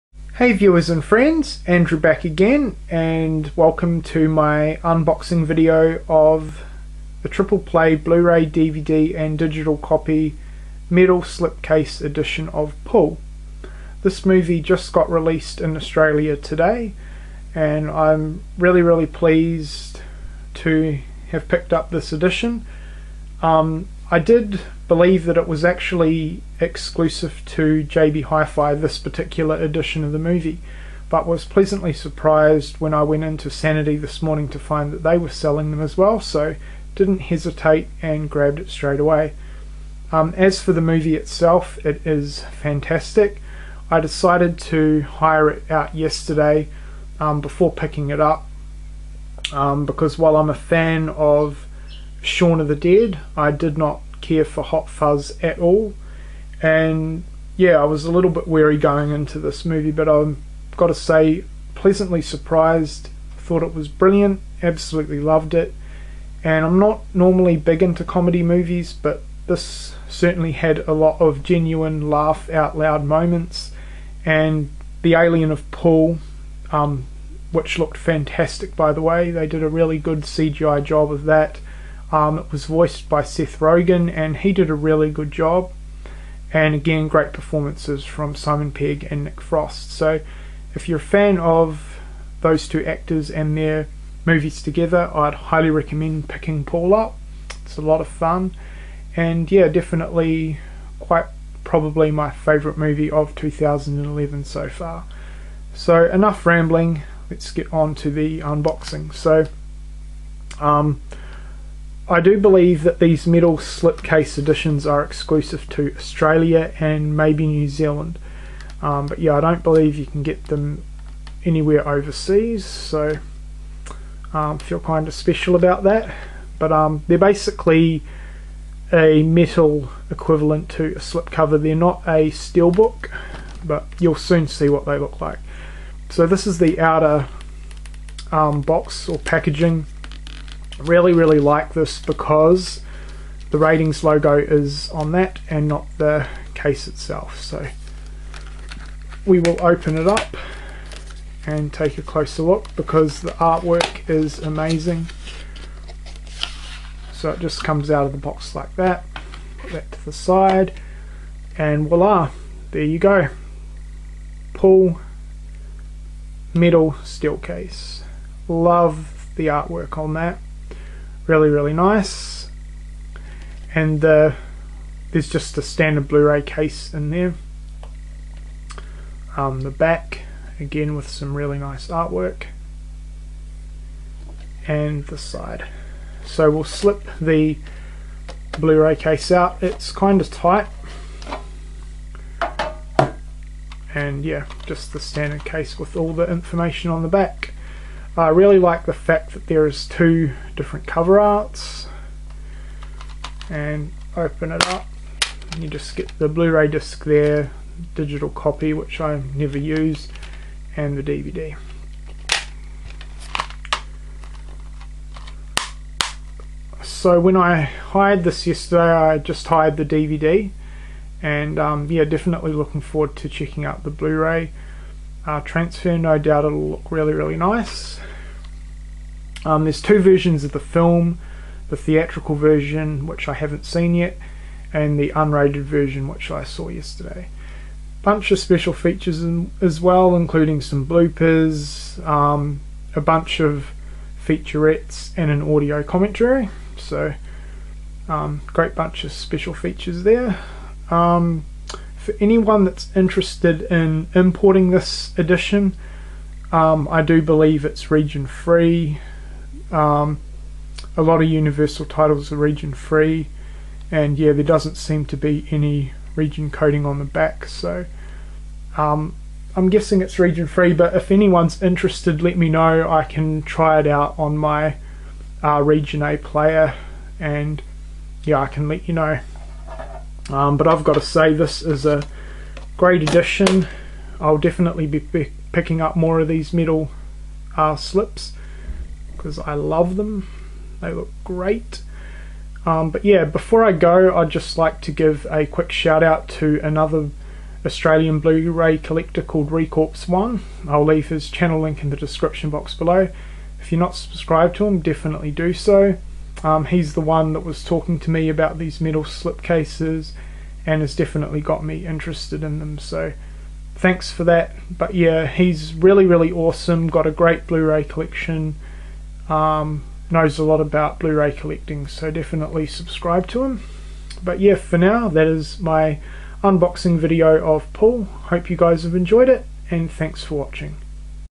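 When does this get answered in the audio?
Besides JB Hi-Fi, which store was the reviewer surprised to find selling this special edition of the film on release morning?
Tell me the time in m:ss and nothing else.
0:33.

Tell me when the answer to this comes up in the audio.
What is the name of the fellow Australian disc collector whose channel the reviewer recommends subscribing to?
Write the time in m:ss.
4:59.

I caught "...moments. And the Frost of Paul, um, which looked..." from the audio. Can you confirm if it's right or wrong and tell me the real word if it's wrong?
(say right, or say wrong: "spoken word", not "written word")
wrong: "Alien", not "Frost".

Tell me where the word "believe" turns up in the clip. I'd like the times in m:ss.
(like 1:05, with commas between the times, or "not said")
0:24, 1:52, 1:59, 4:17.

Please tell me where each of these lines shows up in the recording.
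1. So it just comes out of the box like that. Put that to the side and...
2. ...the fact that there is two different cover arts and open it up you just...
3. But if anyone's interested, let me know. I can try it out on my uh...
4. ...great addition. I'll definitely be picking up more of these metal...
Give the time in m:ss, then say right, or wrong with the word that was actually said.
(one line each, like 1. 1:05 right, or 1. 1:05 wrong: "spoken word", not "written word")
1. 2:37 right
2. 3:18 right
3. 4:30 right
4. 4:42 right.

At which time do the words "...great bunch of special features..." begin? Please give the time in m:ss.
4:08.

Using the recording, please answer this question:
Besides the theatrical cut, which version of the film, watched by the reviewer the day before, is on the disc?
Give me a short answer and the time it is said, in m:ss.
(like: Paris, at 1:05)
Unrated version, at 3:55.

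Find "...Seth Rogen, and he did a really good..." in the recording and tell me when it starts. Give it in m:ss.
1:23.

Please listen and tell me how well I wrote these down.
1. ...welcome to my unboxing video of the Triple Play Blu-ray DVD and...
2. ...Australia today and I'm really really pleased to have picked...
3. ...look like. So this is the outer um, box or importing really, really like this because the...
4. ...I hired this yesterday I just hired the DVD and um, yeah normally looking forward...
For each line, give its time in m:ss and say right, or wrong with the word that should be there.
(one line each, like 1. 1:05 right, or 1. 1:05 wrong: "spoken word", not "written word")
1. 0:03 right
2. 0:15 right
3. 2:14 wrong: "packaging", not "importing"
4. 3:37 wrong: "definitely", not "normally".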